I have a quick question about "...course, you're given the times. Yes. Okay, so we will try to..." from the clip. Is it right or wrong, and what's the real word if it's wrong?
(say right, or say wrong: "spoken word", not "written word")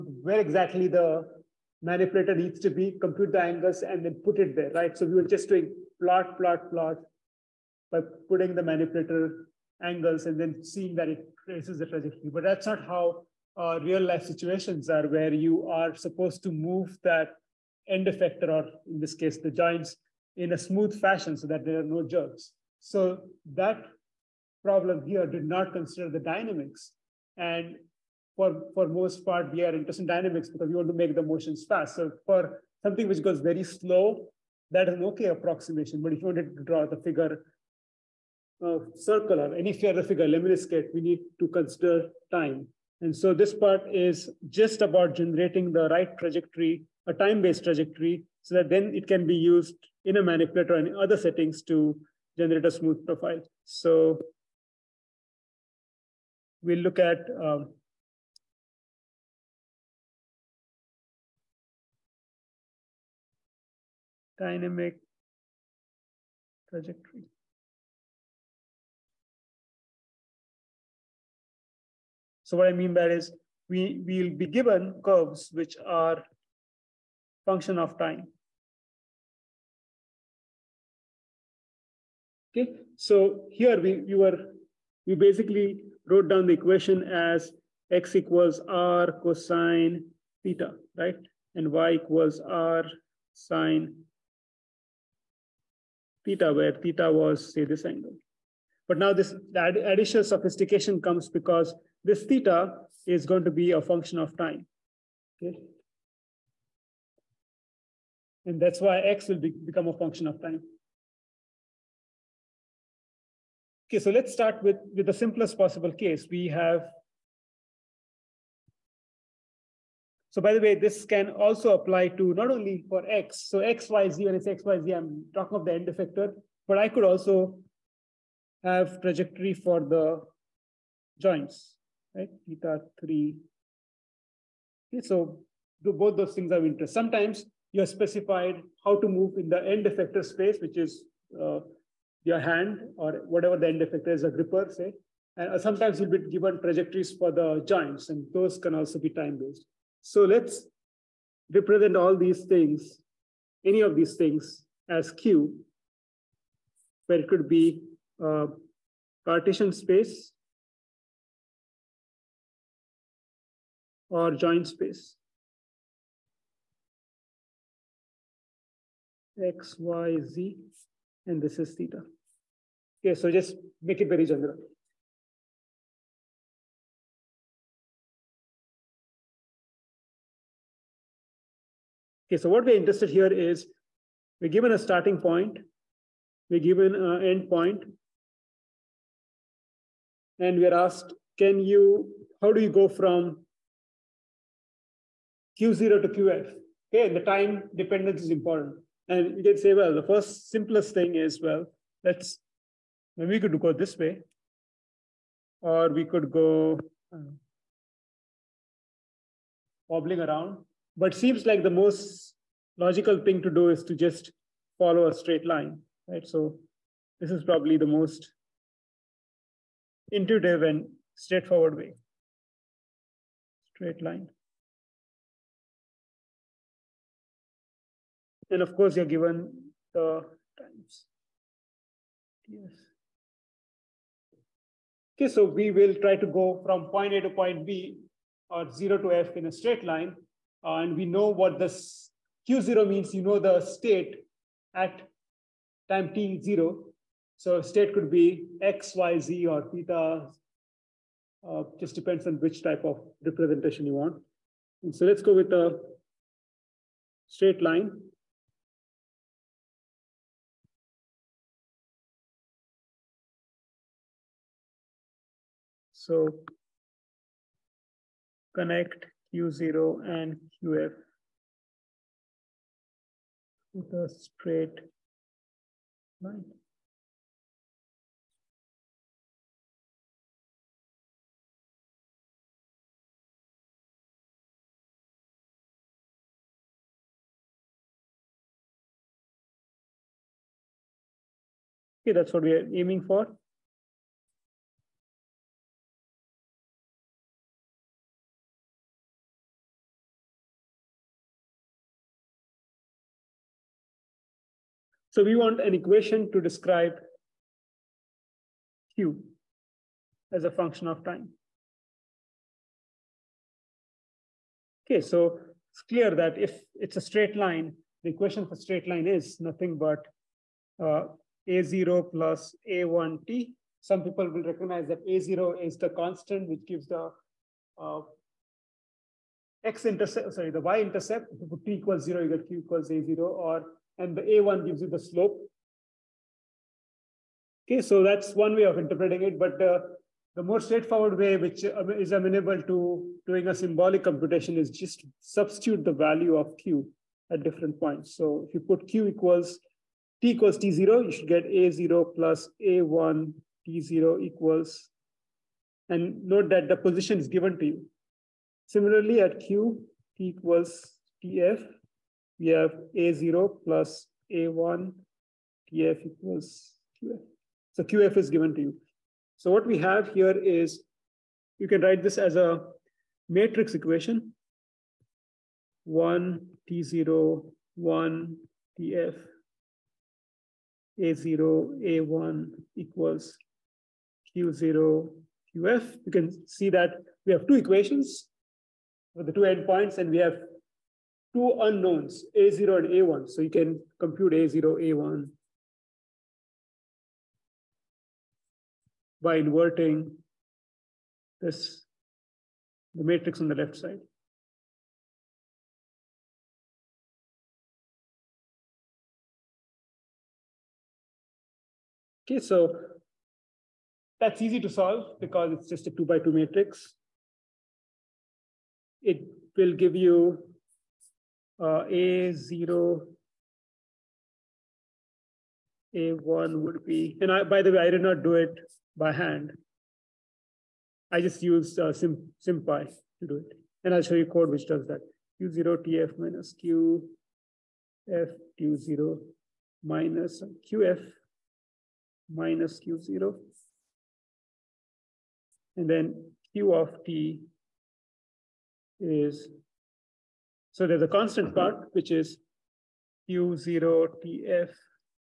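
right.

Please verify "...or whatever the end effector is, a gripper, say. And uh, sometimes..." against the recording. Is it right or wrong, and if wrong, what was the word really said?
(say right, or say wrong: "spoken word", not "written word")
right.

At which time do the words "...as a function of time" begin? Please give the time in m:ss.
5:10.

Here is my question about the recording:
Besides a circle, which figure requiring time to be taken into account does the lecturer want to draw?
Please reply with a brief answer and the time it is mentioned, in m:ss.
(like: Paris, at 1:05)
Lemniscate, at 0:40.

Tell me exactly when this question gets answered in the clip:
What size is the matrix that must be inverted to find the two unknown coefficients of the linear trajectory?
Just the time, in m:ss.
6:55.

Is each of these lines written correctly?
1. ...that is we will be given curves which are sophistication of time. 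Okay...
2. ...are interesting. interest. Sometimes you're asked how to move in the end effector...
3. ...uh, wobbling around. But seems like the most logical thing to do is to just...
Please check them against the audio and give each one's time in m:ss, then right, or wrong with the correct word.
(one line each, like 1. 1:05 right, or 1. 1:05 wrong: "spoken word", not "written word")
1. 1:13 wrong: "function", not "sophistication"
2. 2:16 wrong: "specified", not "asked"
3. 3:27 right.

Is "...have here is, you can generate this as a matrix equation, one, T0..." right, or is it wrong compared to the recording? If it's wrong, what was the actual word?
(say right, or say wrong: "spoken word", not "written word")
wrong: "write", not "generate".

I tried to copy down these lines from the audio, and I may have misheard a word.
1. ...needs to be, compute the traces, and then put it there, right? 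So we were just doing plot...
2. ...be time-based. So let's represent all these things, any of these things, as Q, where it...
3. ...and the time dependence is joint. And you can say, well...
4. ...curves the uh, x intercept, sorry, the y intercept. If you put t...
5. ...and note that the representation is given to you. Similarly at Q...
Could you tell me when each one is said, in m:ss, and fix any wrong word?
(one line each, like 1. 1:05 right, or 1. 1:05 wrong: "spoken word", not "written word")
1. 0:02 wrong: "angles", not "traces"
2. 2:28 right
3. 3:17 wrong: "important", not "joint"
4. 5:26 wrong: "gives", not "curves"
5. 5:55 wrong: "position", not "representation".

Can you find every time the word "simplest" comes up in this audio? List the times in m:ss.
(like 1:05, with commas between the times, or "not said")
1:55, 3:20.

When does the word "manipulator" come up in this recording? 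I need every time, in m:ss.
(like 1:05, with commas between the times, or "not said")
0:01, 0:08, 0:50.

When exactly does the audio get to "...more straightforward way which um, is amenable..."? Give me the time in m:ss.
5:40.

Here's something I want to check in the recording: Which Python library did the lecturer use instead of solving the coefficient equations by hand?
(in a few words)
SymPy.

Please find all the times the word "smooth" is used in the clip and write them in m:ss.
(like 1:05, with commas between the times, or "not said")
0:20, 0:52.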